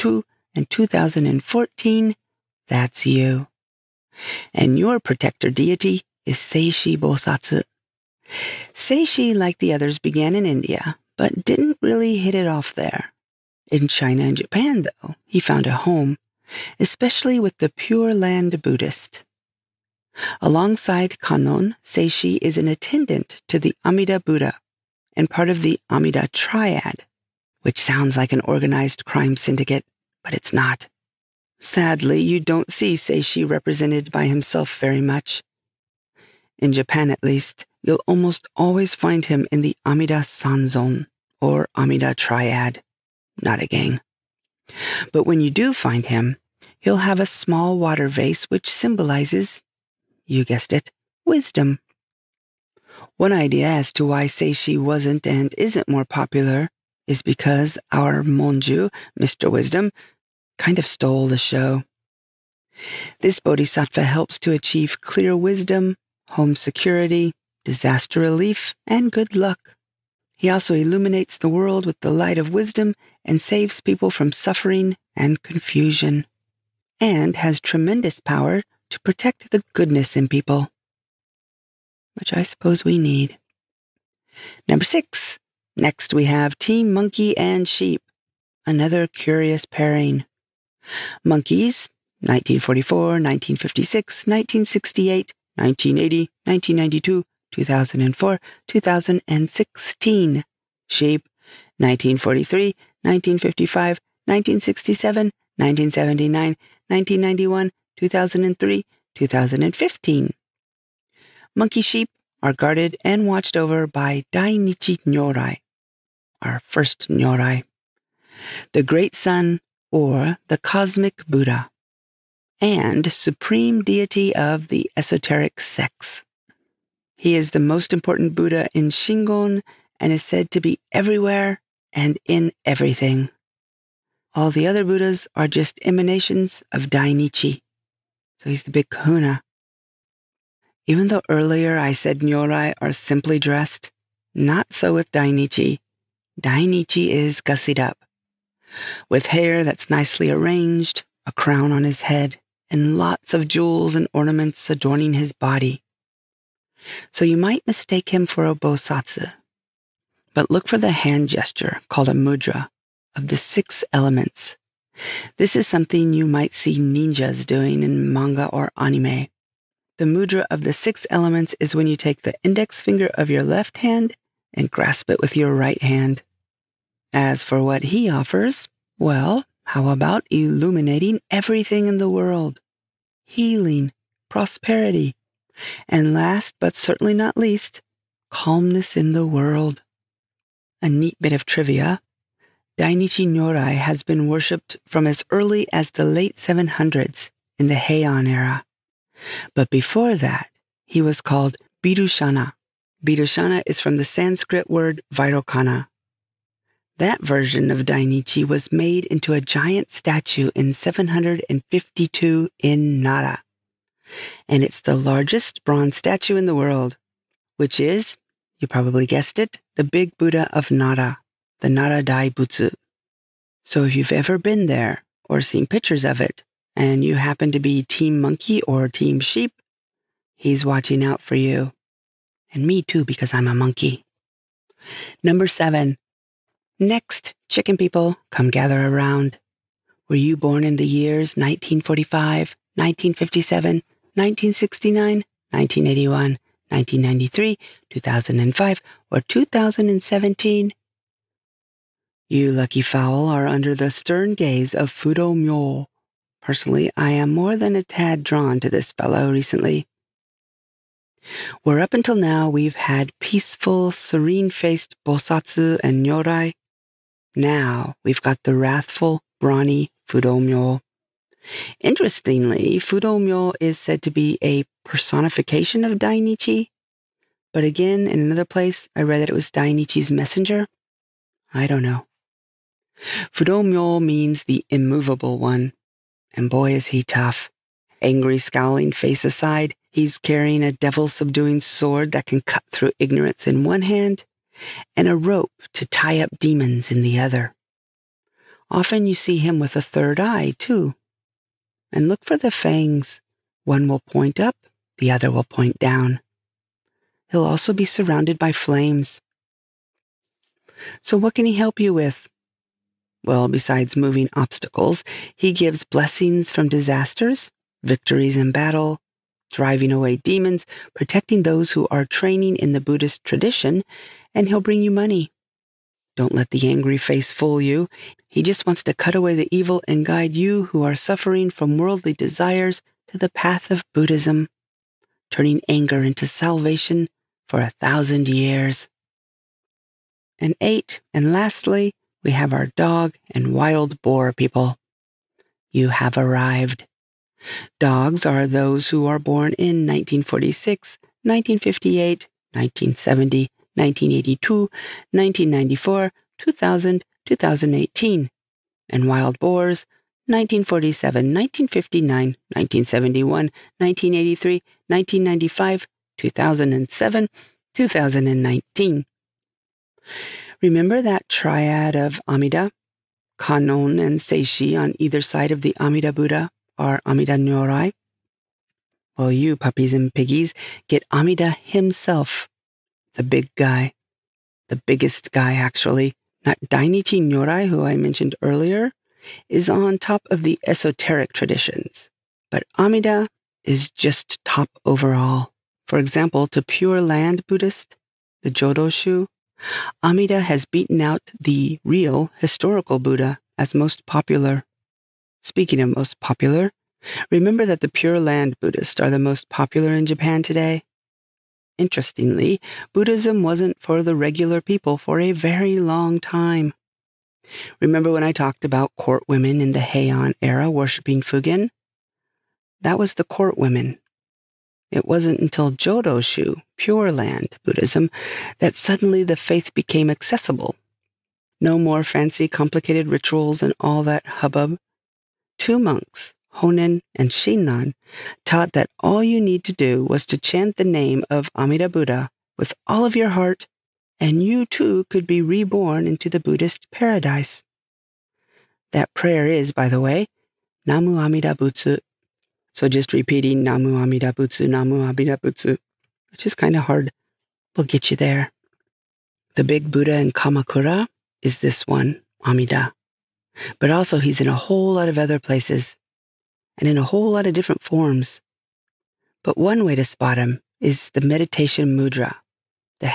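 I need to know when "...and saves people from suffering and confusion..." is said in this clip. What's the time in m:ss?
1:13.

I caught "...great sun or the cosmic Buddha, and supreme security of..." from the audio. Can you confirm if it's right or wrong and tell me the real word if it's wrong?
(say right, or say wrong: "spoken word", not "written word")
wrong: "deity", not "security".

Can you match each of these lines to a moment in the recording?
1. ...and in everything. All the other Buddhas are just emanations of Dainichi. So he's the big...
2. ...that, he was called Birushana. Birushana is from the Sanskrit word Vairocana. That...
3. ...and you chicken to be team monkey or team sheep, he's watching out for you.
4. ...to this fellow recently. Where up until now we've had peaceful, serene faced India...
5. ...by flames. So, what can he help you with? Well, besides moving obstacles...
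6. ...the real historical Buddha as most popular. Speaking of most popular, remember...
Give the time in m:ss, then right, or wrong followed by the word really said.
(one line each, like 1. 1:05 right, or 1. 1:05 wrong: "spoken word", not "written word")
1. 2:11 right
2. 3:20 right
3. 3:46 wrong: "happen", not "chicken"
4. 4:18 wrong: "Bosatsu", not "India"
5. 5:08 right
6. 6:41 right.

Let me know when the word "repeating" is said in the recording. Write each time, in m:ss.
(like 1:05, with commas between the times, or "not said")
7:33.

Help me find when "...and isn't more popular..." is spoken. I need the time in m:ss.
0:55.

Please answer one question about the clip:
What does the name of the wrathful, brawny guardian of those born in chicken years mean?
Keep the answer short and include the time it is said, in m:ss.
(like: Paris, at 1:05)
The immovable one, at 4:44.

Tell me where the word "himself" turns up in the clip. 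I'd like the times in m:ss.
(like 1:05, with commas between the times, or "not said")
0:34, 6:21.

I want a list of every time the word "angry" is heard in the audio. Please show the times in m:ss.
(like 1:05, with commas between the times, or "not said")
4:47, 5:26.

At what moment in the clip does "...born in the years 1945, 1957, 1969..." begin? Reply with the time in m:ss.
4:00.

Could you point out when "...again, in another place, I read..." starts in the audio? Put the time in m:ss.
4:37.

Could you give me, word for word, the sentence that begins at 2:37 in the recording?
So you might mistake him for a bosatsu, but look for the hand gesture called a mudra of the six elements.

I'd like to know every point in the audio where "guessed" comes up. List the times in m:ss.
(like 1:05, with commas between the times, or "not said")
0:50, 3:39.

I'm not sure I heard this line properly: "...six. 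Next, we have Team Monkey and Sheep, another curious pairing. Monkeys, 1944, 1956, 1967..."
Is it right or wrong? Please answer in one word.
wrong.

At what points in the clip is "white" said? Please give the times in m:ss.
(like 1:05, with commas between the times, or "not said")
not said.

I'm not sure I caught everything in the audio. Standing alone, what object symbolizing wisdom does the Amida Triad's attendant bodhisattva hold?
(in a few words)
Small water vase.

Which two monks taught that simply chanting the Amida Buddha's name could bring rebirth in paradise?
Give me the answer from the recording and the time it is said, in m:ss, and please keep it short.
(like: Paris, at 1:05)
Honen and Shinran, at 7:16.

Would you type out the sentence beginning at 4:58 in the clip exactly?
Often you see him with a third eye, too.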